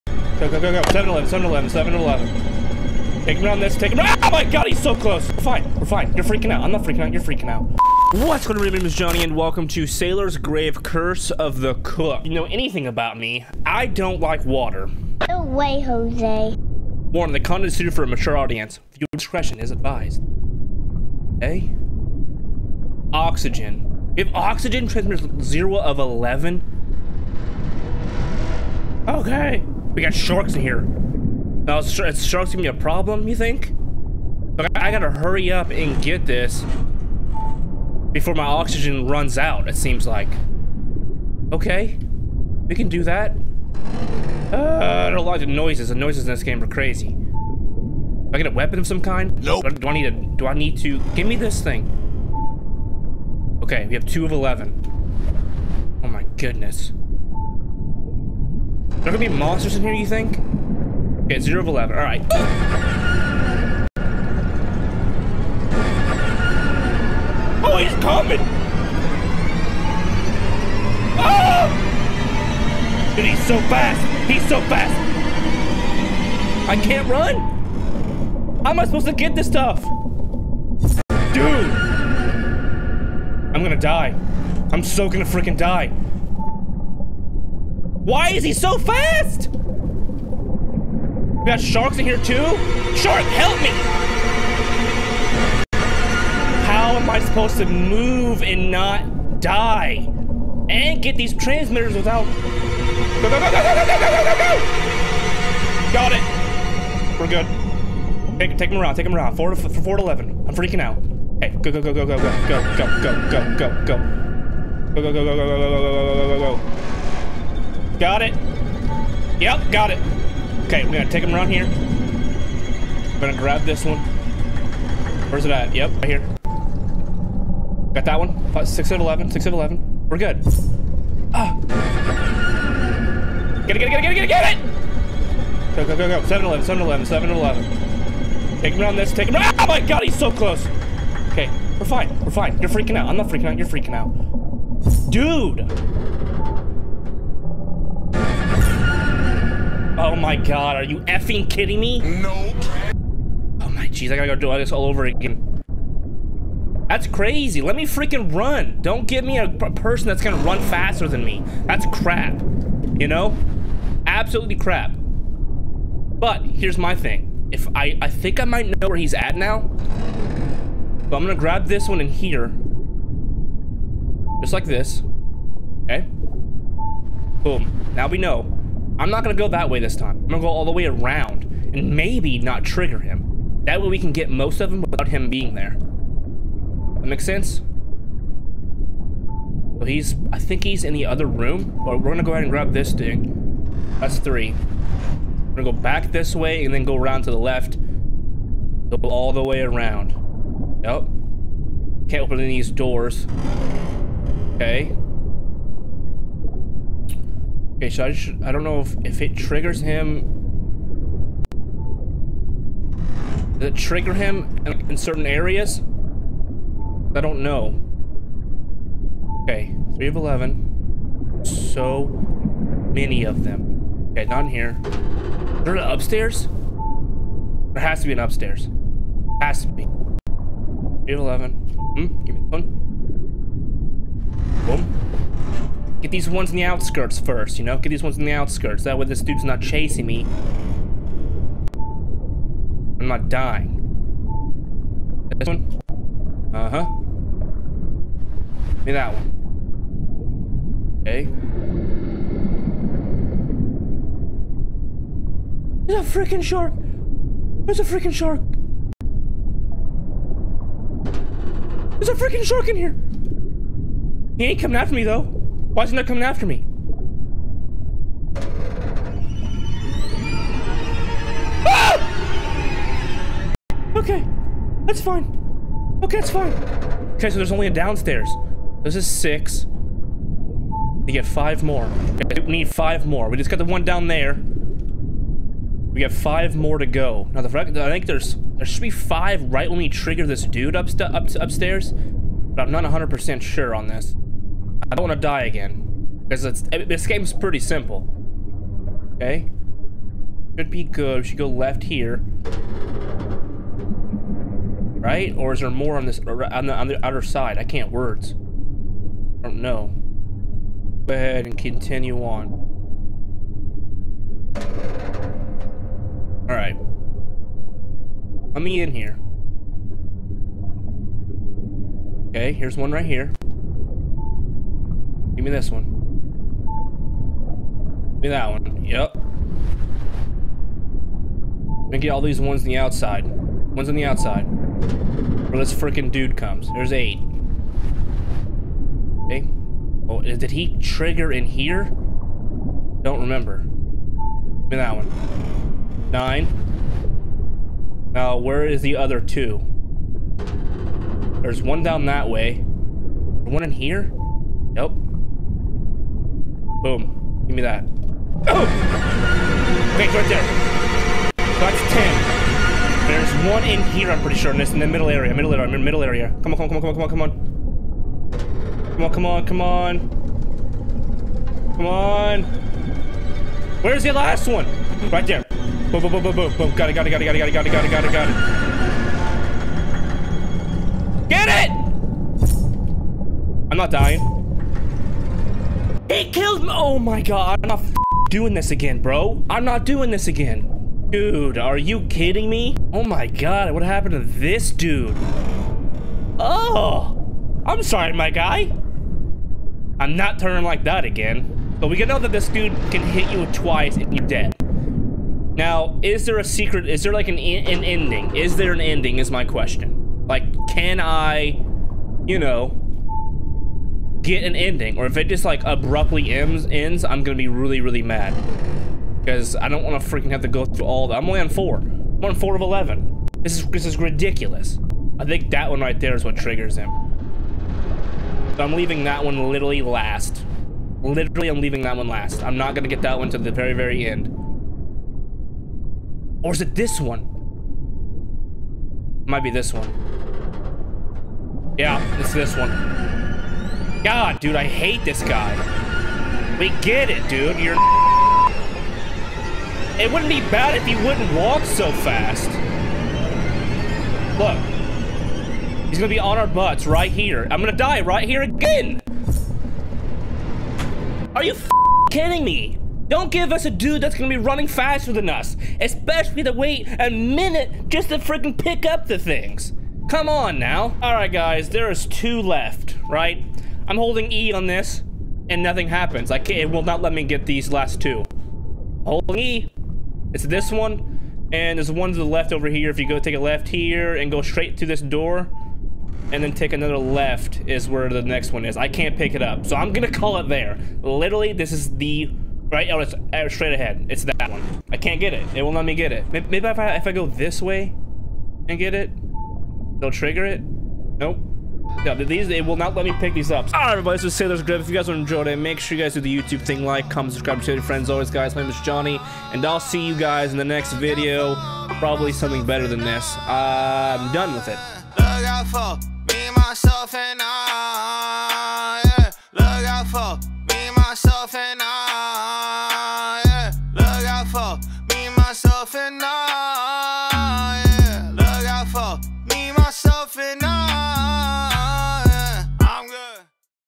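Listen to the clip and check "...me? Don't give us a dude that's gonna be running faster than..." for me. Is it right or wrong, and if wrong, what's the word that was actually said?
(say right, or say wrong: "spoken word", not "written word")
right.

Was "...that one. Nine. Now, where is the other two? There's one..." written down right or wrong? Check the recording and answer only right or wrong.
right.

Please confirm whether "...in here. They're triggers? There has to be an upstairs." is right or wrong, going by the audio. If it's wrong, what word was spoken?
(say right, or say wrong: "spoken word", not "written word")
wrong: "upstairs", not "triggers".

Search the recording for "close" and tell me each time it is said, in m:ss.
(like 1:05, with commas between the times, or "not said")
0:04, 2:20.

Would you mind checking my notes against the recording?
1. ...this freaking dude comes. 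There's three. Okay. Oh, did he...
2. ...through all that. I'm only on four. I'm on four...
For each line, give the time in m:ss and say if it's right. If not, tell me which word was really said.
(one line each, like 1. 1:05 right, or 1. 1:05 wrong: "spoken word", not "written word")
1. 5:35 wrong: "eight", not "three"
2. 7:00 right.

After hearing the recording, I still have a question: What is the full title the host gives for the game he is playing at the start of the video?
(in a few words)
Sailor's Grave Curse of the Cook.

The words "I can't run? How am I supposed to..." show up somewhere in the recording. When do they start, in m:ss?
1:16.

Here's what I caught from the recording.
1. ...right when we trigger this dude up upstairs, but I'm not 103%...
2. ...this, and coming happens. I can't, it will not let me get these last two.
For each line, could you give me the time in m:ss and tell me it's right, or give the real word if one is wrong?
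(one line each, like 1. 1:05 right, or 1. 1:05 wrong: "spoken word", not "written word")
1. 4:49 wrong: "100", not "103"
2. 7:54 wrong: "nothing", not "coming".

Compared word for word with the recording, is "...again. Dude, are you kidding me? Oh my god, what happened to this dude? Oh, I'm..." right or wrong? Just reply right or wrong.
right.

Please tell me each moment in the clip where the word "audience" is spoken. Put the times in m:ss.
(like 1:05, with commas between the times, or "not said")
0:18.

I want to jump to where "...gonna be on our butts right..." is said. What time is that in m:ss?
7:35.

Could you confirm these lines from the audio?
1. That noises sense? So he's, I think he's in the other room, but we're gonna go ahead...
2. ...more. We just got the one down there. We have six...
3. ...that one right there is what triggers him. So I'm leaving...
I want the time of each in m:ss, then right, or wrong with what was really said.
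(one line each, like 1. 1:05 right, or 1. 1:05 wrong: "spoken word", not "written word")
1. 3:07 wrong: "makes", not "noises"
2. 4:43 wrong: "five", not "six"
3. 7:05 right.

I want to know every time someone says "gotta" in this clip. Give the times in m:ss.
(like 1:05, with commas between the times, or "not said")
0:34, 2:34.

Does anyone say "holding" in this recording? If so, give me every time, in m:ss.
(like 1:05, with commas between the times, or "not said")
7:53, 7:59.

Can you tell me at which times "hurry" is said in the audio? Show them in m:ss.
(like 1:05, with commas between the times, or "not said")
0:35.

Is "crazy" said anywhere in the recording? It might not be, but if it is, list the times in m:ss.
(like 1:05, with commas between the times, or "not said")
0:46, 2:37.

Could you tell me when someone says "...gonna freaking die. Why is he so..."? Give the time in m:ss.
1:25.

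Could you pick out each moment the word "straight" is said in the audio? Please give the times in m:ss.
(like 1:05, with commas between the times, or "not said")
8:04, 8:13.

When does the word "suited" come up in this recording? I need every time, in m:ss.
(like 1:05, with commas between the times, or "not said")
0:17.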